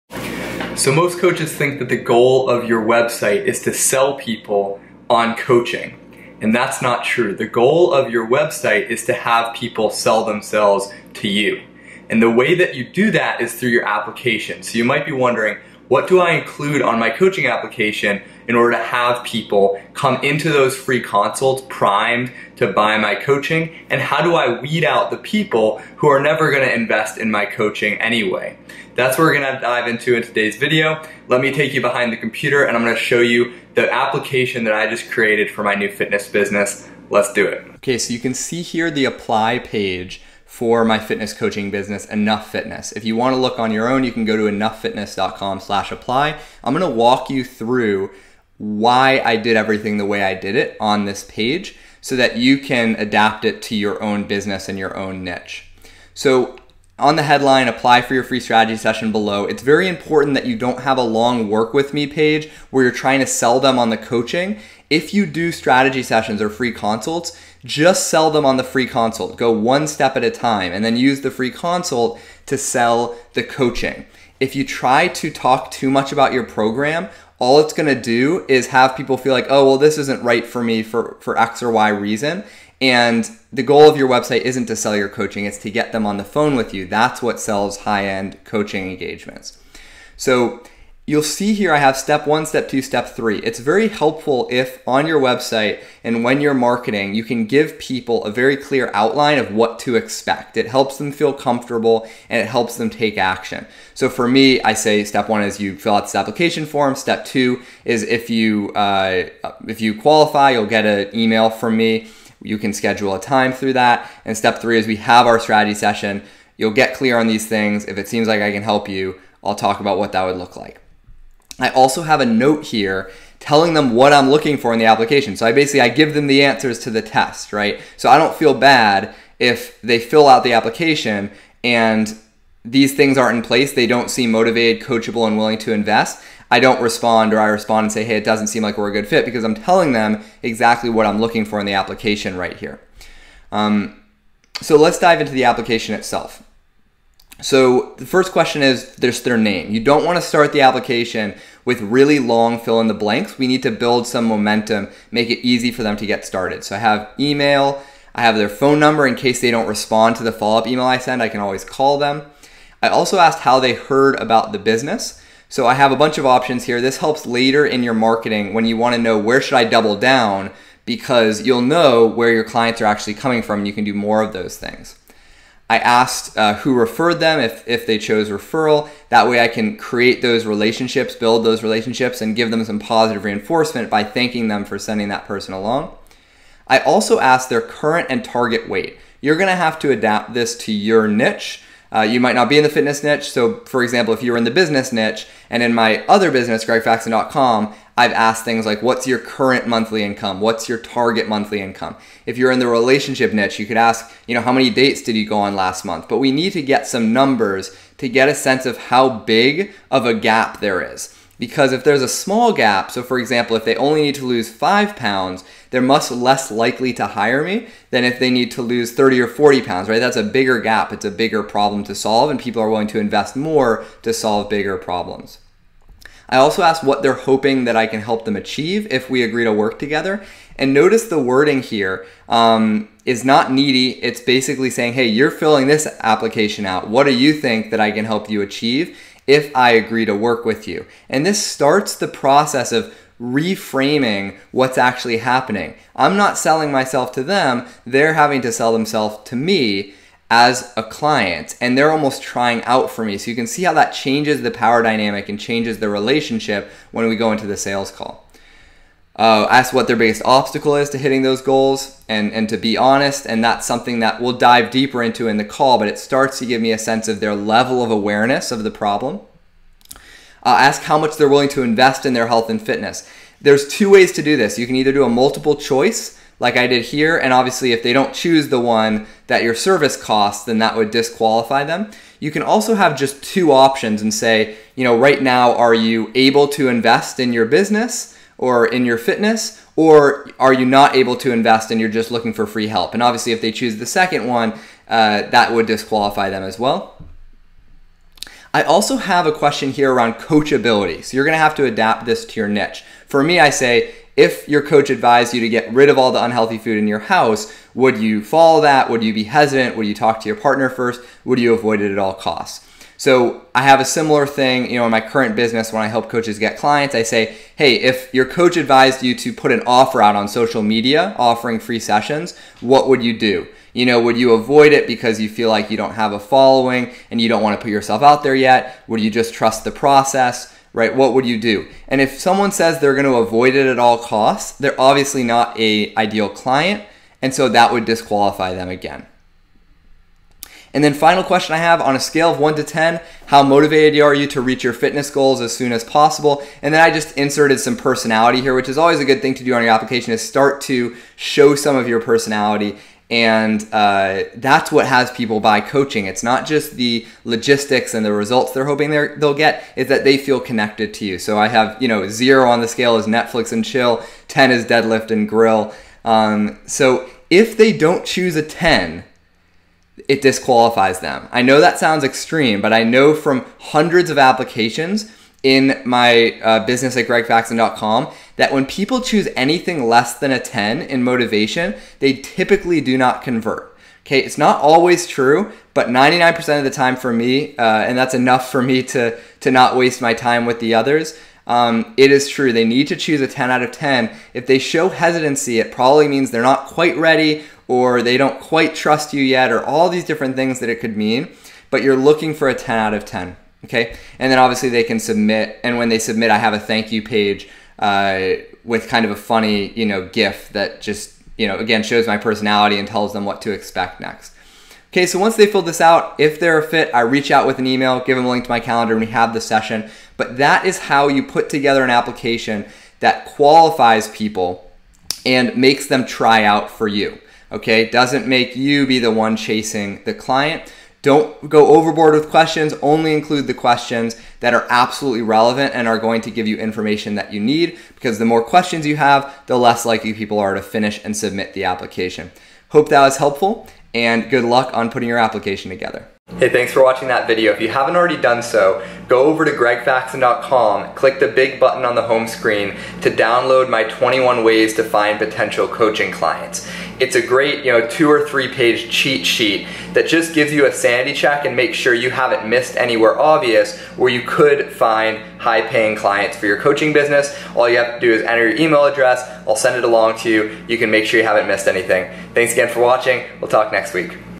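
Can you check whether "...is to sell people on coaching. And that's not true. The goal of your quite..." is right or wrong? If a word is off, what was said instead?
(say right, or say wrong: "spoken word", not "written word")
wrong: "website", not "quite".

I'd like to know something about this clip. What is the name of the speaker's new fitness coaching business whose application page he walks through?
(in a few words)
Enough Fitness.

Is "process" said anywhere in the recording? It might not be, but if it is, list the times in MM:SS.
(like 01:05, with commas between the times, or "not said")
04:02, 05:29.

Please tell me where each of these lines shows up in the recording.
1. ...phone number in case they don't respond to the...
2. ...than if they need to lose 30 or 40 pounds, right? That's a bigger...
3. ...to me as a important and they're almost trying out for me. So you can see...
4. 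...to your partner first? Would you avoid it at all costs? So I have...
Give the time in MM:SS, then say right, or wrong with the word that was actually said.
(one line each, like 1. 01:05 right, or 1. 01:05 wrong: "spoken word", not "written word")
1. 02:38 right
2. 03:37 right
3. 04:09 wrong: "client", not "important"
4. 05:10 right.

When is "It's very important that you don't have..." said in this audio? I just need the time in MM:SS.
00:59.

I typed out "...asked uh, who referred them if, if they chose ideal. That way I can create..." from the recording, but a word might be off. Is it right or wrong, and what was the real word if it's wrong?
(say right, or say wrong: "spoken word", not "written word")
wrong: "referral", not "ideal".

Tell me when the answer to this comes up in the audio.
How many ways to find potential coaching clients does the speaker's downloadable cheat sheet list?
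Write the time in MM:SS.
07:33.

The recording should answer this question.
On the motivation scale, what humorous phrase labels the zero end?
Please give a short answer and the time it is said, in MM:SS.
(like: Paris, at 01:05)
Netflix and chill, at 06:03.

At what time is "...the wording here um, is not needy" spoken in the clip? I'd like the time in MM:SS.
03:51.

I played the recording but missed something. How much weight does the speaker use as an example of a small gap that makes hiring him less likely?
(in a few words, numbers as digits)
5 pounds.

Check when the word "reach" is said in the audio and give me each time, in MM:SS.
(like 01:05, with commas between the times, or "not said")
05:44, 06:57.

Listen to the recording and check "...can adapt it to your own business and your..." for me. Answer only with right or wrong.
right.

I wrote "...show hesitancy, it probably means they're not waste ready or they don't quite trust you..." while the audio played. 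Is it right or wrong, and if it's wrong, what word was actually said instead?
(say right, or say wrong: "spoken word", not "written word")
wrong: "quite", not "waste".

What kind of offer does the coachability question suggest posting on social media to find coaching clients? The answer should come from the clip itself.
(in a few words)
free sessions.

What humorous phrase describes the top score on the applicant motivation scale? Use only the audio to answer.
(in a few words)
deadlift and grill.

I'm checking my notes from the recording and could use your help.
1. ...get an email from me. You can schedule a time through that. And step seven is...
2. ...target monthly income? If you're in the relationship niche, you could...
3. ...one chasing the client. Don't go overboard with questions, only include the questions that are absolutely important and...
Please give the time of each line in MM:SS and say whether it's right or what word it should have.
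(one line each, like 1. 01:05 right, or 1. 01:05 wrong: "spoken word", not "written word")
1. 01:50 wrong: "three", not "seven"
2. 03:20 right
3. 07:09 wrong: "relevant", not "important".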